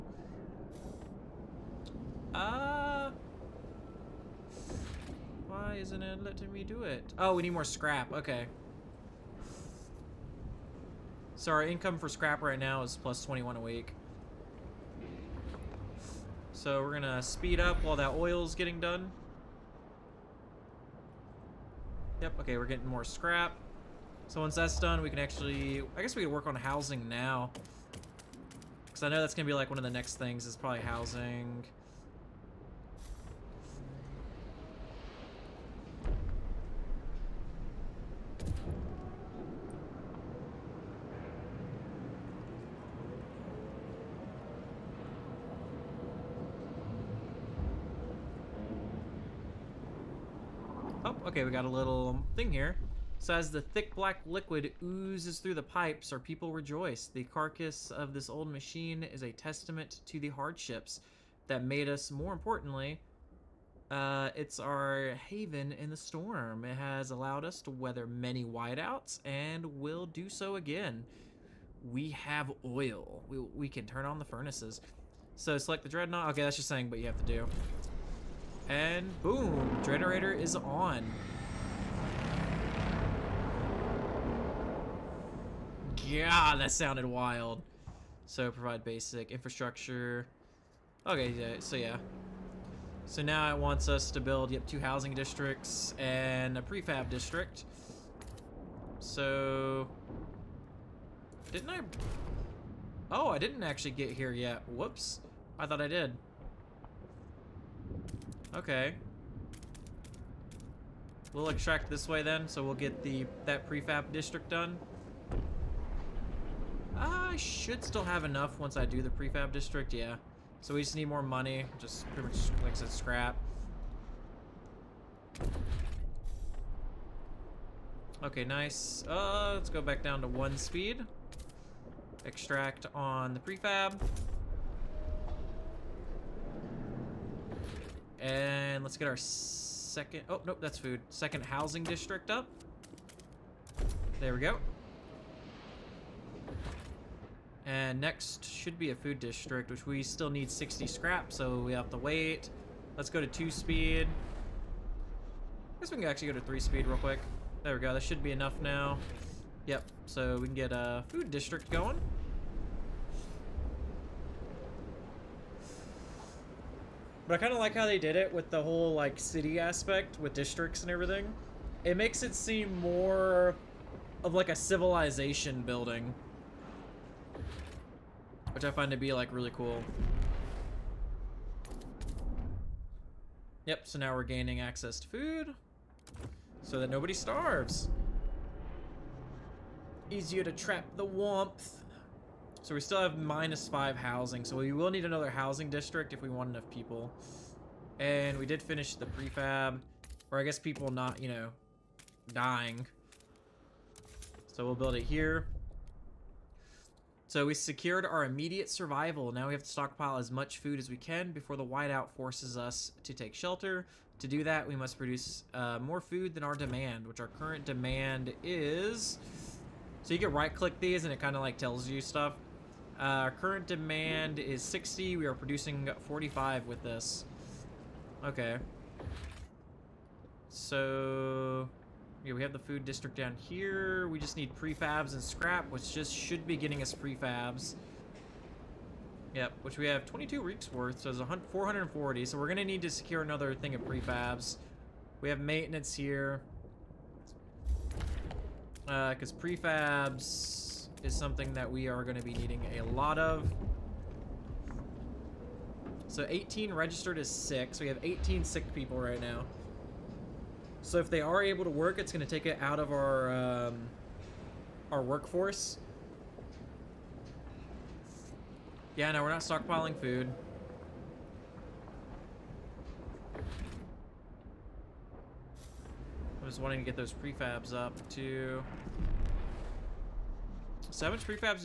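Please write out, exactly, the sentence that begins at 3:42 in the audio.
Uh, our current demand is 60.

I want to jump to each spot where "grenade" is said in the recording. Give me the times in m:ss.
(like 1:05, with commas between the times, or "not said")
not said.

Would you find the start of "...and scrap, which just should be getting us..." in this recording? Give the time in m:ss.
3:55.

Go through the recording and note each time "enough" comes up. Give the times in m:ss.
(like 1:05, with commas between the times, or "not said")
1:58, 2:38, 3:16.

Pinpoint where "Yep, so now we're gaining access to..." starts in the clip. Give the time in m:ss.
3:03.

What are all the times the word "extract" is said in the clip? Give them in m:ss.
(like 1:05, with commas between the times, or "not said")
1:51, 2:12.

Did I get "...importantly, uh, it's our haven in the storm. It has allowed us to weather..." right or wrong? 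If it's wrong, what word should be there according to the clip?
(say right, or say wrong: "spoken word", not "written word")
right.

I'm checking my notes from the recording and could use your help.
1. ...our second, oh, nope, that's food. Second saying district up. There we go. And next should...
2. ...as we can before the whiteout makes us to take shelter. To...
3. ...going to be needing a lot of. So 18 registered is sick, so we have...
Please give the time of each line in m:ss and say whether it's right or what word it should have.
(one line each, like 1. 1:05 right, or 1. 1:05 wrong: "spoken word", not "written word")
1. 2:19 wrong: "housing", not "saying"
2. 3:30 wrong: "forces", not "makes"
3. 4:12 right.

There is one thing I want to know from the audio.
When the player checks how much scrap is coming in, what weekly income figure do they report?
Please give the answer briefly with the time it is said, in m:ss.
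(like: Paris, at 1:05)
+21, at 0:13.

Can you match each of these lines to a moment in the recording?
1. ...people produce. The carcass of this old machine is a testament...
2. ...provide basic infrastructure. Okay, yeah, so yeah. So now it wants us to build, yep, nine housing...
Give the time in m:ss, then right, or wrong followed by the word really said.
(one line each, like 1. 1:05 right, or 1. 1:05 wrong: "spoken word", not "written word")
1. 0:56 wrong: "rejoice", not "produce"
2. 1:28 wrong: "two", not "nine".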